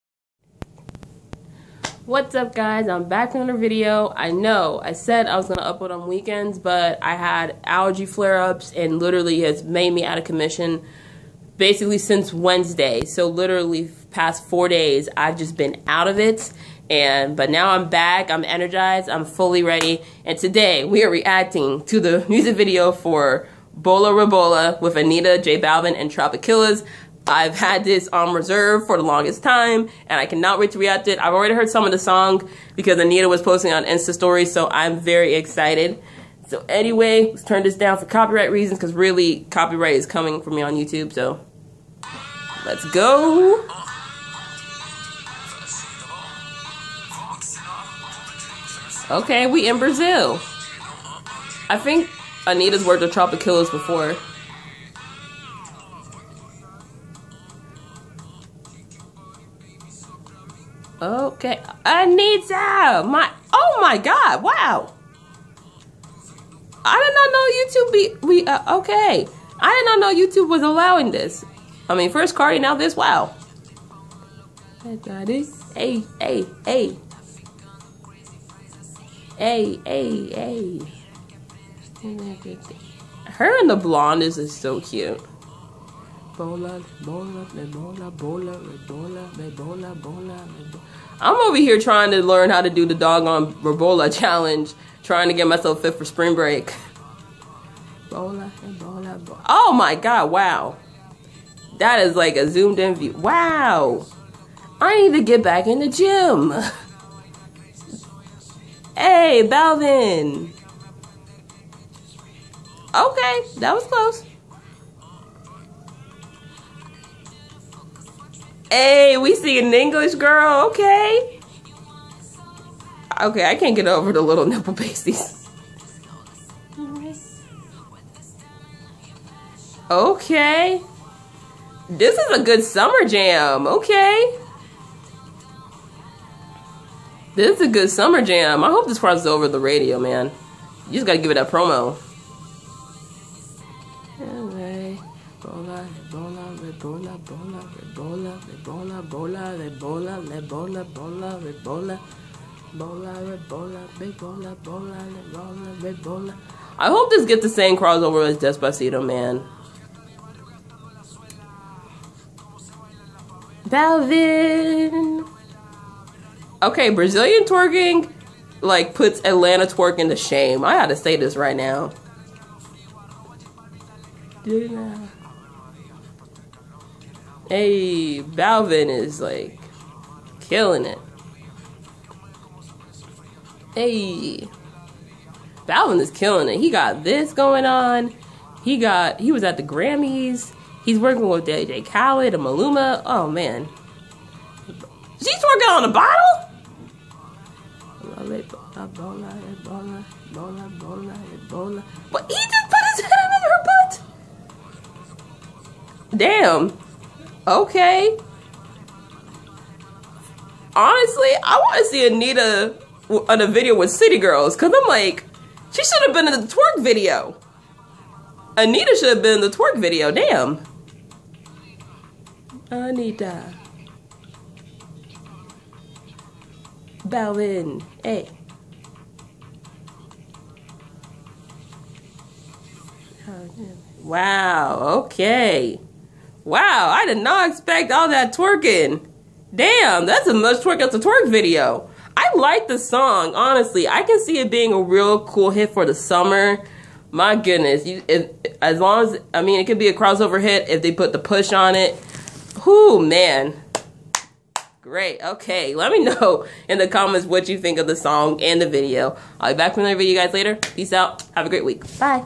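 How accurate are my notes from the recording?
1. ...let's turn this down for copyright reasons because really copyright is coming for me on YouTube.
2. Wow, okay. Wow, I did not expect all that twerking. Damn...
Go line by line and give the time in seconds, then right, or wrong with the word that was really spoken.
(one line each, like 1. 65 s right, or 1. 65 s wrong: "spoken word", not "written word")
1. 37 s right
2. 234 s right.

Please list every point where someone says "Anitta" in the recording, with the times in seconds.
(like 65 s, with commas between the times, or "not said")
24 s, 32 s, 52 s, 61 s, 212 s, 218 s, 222 s.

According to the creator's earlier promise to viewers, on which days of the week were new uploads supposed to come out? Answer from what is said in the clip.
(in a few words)
Weekends.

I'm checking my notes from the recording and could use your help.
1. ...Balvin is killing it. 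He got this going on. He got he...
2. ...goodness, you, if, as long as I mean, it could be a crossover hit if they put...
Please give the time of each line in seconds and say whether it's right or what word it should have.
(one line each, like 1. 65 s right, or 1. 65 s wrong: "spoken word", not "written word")
1. 185 s right
2. 247 s right.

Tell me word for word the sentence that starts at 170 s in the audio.
I gotta say this right now.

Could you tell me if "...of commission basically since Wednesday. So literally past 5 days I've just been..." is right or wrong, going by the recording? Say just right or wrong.
wrong.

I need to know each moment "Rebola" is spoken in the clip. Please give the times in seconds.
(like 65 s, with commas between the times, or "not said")
24 s, 93 s.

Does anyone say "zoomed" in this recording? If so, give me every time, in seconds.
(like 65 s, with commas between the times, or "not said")
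102 s.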